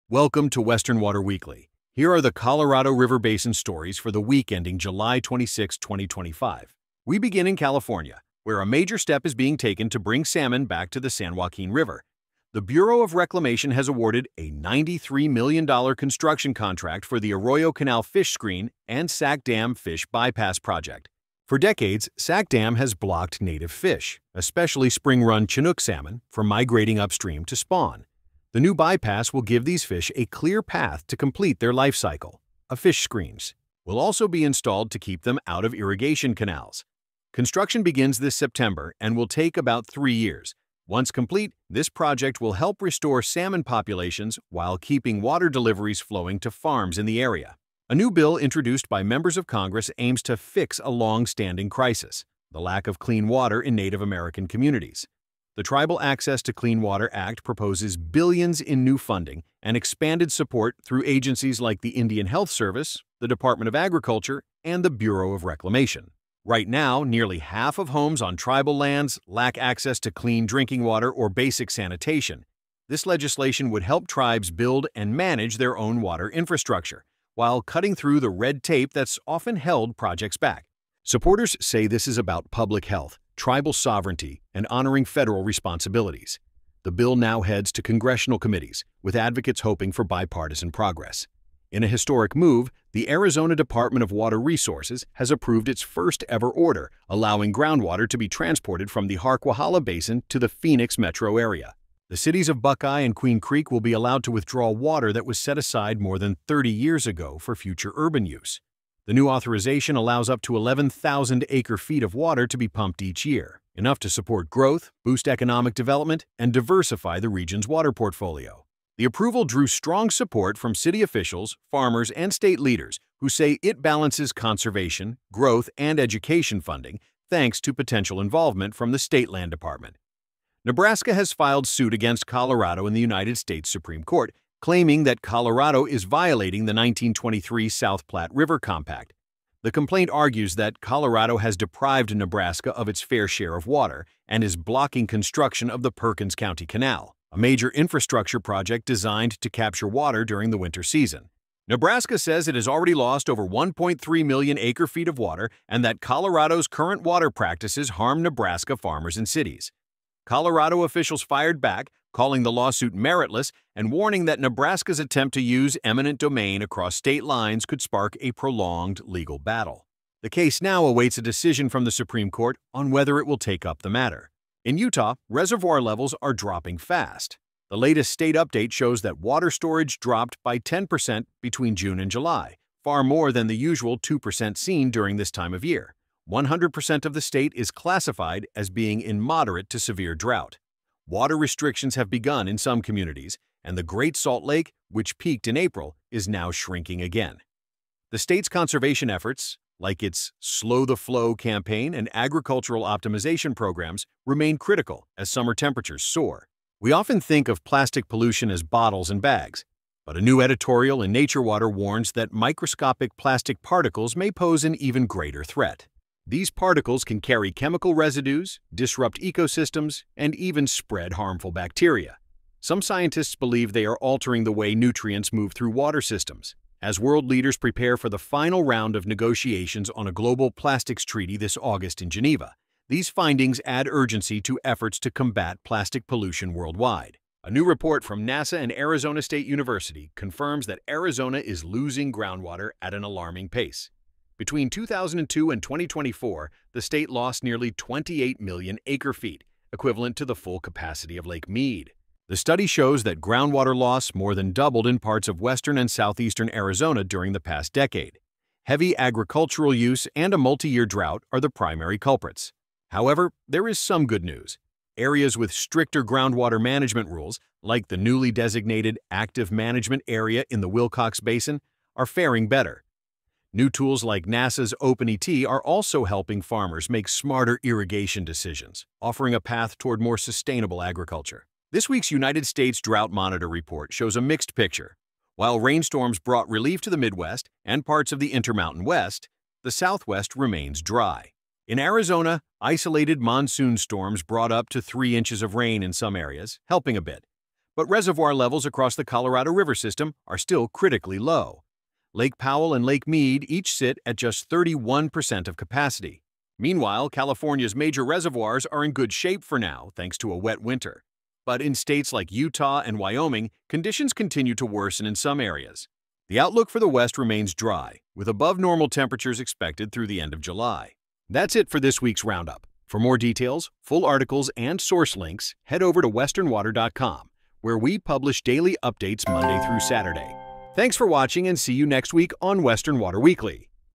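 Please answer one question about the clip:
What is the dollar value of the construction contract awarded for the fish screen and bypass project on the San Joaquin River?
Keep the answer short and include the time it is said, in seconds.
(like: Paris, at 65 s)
$93 million, at 14 s.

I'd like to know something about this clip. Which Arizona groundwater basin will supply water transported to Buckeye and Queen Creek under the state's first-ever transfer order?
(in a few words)
Harquahala Basin.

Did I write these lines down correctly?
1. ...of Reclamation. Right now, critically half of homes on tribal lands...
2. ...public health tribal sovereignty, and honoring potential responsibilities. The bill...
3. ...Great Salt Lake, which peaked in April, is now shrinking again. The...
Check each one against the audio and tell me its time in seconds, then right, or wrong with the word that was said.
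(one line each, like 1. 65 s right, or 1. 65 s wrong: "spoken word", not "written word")
1. 65 s wrong: "nearly", not "critically"
2. 82 s wrong: "federal", not "potential"
3. 193 s right.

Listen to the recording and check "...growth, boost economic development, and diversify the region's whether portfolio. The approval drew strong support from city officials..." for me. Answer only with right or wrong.
wrong.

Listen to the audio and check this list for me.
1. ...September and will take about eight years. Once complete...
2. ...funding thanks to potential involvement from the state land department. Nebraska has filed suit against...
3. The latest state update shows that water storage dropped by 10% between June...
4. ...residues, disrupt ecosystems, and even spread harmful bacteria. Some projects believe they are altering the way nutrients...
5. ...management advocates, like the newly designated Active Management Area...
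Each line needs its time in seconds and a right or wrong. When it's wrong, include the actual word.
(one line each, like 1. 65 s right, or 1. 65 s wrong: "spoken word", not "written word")
1. 38 s wrong: "three", not "eight"
2. 126 s right
3. 177 s right
4. 217 s wrong: "scientists", not "projects"
5. 266 s wrong: "rules", not "advocates".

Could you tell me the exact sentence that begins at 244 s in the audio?
Between 2002 and 2024, the state lost nearly 28 million acre-feet, equivalent to the full capacity of Lake Mead.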